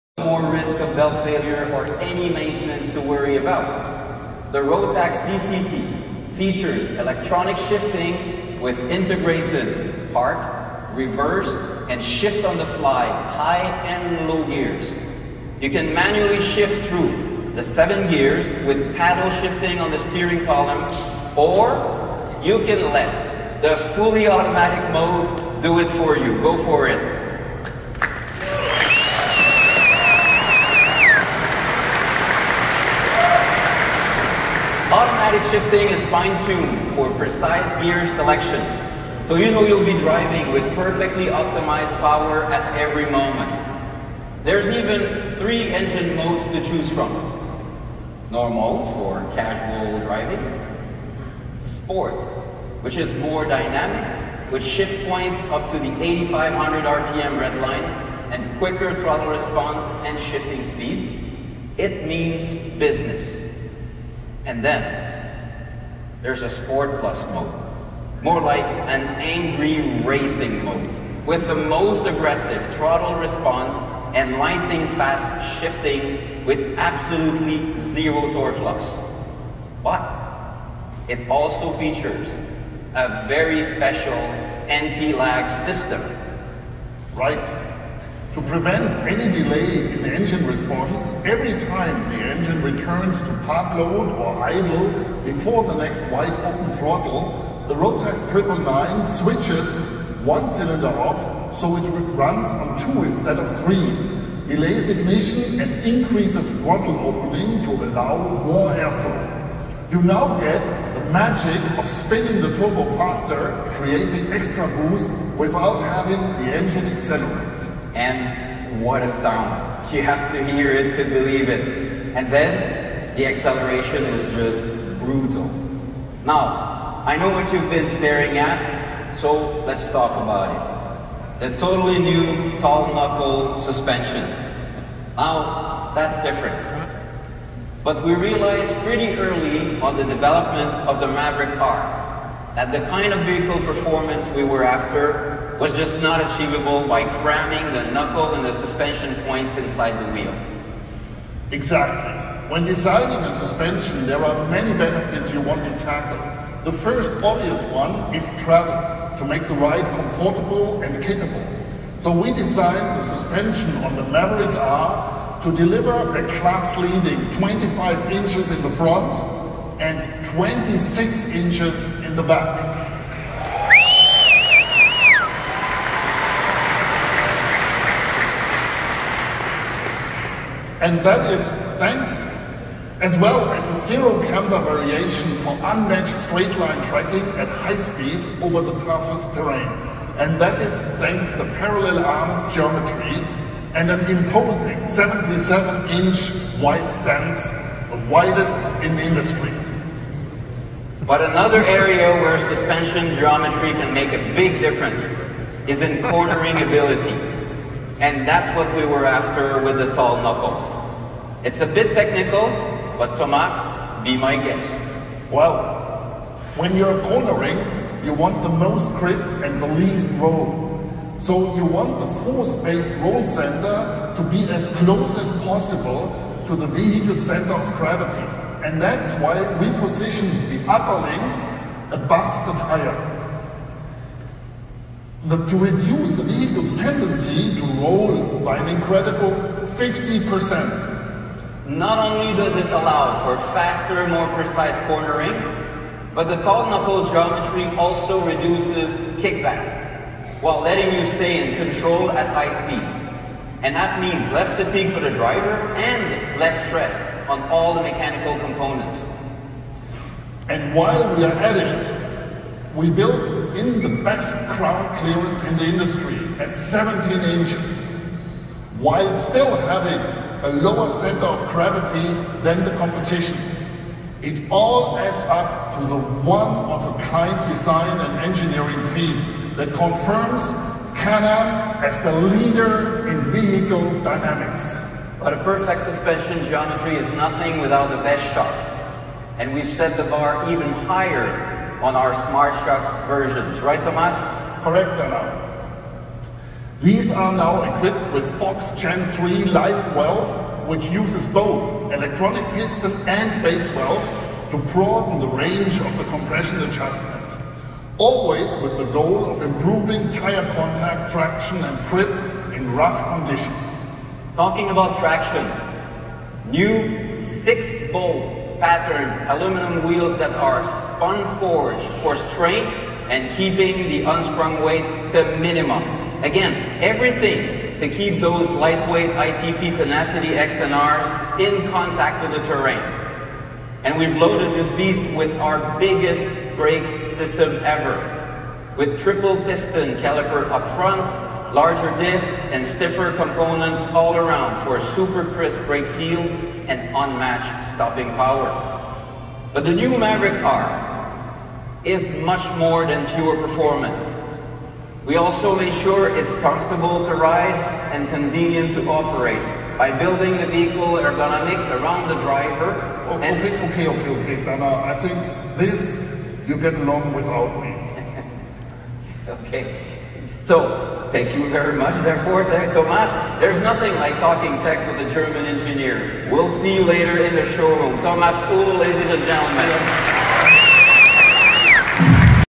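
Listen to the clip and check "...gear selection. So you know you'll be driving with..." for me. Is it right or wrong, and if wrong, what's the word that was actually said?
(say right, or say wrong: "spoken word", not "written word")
right.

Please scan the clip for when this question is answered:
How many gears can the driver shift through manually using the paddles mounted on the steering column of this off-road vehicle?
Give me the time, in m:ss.
0:17.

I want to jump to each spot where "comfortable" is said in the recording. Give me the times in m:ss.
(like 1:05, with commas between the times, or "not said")
2:39, 5:56.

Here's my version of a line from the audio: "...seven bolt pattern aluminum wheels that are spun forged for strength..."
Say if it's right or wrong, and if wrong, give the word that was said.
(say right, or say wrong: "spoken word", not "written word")
wrong: "six", not "seven".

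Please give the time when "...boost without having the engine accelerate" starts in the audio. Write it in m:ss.
1:54.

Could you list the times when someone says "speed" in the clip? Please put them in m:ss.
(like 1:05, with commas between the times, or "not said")
1:00, 3:07, 4:12.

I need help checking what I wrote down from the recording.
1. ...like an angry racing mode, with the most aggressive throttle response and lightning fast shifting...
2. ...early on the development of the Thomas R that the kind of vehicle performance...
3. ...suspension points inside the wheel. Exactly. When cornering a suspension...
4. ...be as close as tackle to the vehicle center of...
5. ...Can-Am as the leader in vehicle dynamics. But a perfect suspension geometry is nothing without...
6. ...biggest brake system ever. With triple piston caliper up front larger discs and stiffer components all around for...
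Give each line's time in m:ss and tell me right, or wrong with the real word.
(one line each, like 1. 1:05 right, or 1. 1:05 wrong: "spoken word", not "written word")
1. 1:08 right
2. 2:19 wrong: "Maverick", not "Thomas"
3. 2:28 wrong: "designing", not "cornering"
4. 3:44 wrong: "possible", not "tackle"
5. 4:41 right
6. 5:35 right.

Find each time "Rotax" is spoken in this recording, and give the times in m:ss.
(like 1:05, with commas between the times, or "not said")
0:04, 1:37.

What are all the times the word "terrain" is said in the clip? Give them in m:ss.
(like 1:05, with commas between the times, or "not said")
3:09, 5:32.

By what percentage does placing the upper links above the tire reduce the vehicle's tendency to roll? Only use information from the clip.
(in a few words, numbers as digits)
50%.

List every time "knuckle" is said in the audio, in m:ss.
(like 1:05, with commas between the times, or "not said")
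2:12, 2:27, 3:30, 4:06.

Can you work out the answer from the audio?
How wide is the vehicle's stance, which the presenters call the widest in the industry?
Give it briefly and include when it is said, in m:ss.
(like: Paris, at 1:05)
77 inches, at 3:14.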